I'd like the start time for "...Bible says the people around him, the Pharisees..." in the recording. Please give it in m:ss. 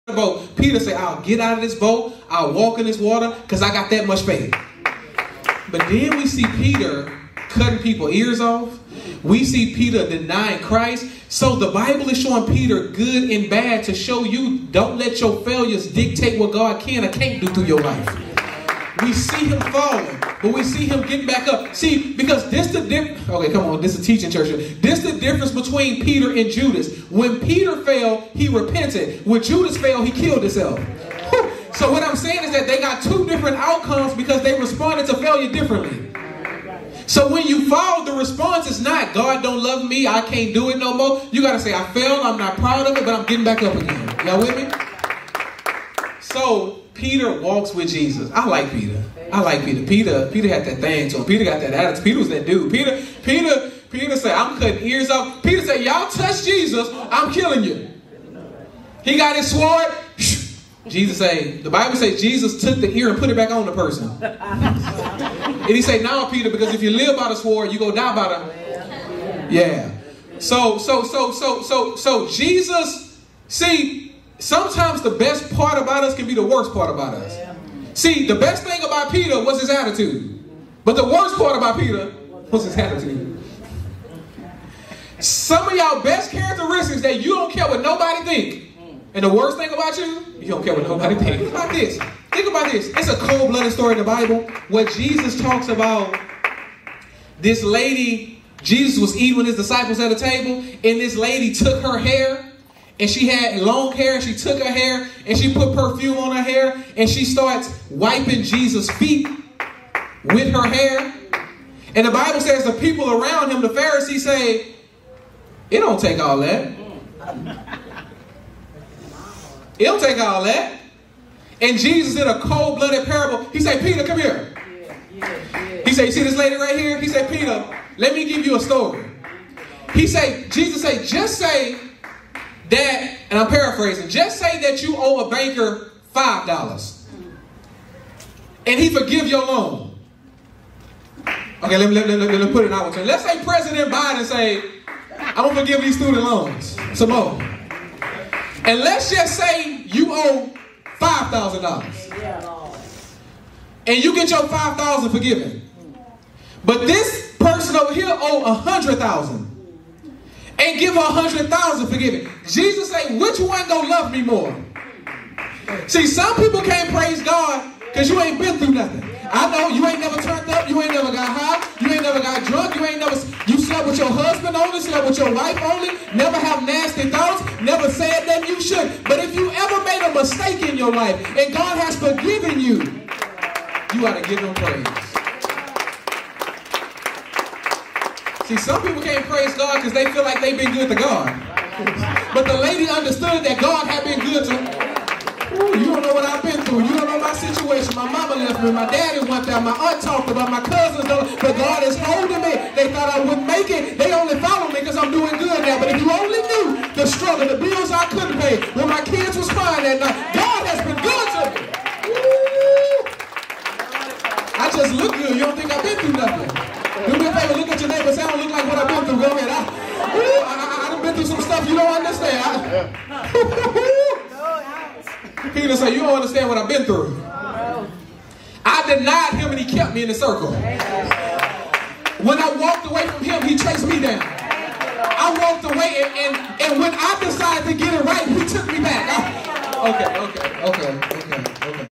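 1:52.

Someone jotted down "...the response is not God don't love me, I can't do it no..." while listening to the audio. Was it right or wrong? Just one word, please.
right.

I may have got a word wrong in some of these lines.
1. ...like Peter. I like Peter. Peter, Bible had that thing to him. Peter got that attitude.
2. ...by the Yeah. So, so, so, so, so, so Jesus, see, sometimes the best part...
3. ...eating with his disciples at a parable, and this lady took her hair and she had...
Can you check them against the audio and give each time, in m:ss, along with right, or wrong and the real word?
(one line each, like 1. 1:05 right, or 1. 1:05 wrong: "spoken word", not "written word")
1. 0:48 wrong: "Peter", not "Bible"
2. 1:08 right
3. 1:39 wrong: "table", not "parable".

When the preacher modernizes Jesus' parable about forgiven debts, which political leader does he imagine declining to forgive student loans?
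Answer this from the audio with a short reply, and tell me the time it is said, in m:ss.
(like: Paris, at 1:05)
President Biden, at 2:23.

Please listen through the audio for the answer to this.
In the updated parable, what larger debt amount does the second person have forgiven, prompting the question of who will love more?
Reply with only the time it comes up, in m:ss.
2:38.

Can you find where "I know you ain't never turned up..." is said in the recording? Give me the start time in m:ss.
2:49.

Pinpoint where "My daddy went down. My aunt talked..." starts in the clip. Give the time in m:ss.
3:18.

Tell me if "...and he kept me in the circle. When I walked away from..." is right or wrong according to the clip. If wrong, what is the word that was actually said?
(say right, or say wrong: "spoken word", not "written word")
right.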